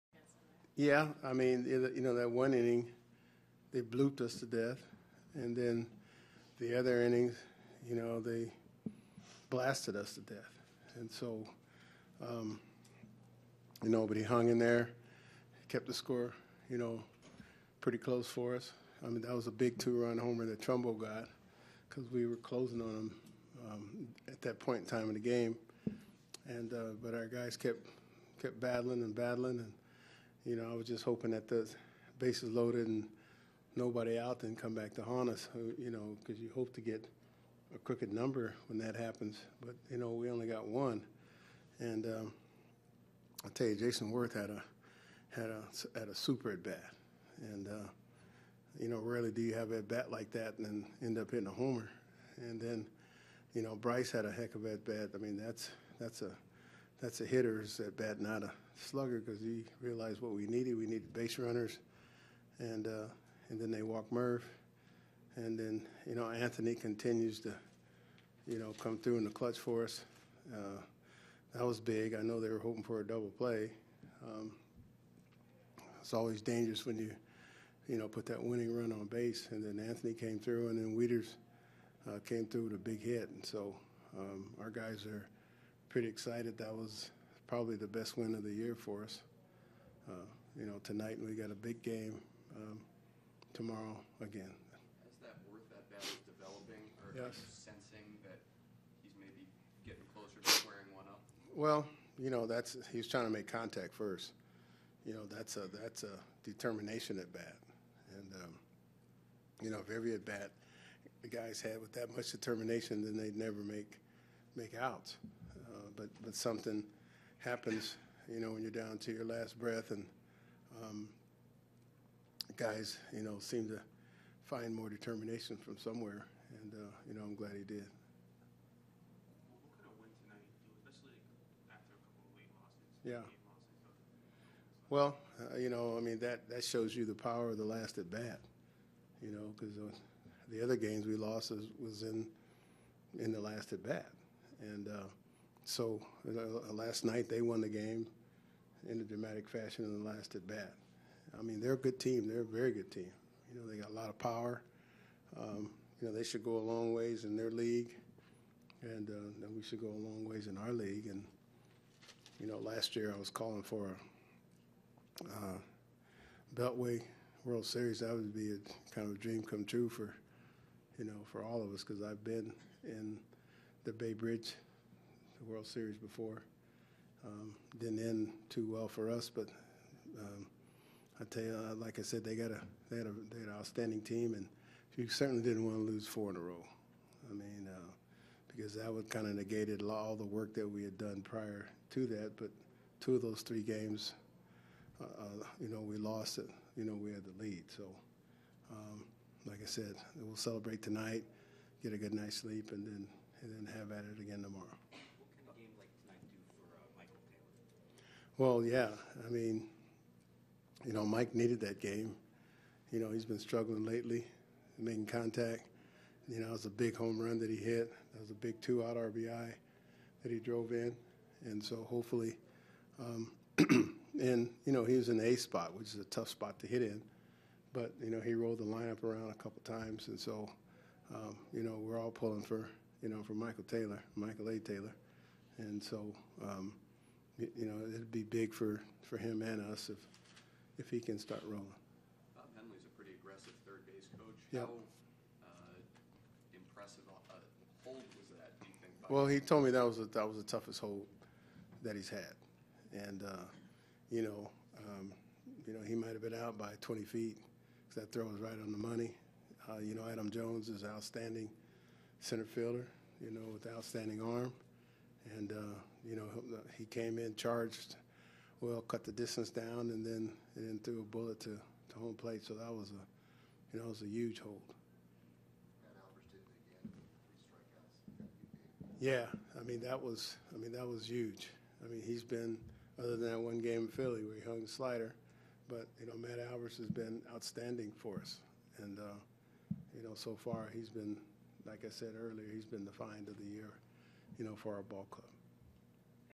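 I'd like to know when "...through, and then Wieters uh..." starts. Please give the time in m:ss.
1:20.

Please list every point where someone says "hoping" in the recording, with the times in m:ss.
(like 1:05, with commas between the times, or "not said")
0:31, 1:12.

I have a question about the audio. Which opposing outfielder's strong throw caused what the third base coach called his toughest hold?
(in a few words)
Adam Jones.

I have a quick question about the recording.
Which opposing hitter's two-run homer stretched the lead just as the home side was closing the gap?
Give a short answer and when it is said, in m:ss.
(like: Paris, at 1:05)
Trumbo, at 0:20.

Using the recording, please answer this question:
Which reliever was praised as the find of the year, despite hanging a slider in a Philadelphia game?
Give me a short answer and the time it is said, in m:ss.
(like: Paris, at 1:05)
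Matt Albers, at 4:46.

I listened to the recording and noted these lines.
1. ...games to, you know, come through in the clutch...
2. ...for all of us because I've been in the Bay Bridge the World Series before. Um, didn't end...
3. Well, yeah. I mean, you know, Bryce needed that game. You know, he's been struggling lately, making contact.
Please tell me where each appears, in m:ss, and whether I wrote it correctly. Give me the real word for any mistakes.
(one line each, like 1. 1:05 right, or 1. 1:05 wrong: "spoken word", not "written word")
1. 1:06 wrong: "continues", not "games"
2. 2:51 right
3. 3:28 wrong: "Mike", not "Bryce".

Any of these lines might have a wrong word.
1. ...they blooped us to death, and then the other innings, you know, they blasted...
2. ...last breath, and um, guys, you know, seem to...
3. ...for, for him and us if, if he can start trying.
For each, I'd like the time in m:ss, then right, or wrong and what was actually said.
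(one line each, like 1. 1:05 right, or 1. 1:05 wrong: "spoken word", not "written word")
1. 0:03 right
2. 1:59 right
3. 3:58 wrong: "rolling", not "trying".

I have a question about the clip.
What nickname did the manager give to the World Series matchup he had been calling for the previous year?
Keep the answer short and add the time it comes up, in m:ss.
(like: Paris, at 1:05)
Beltway World Series, at 2:46.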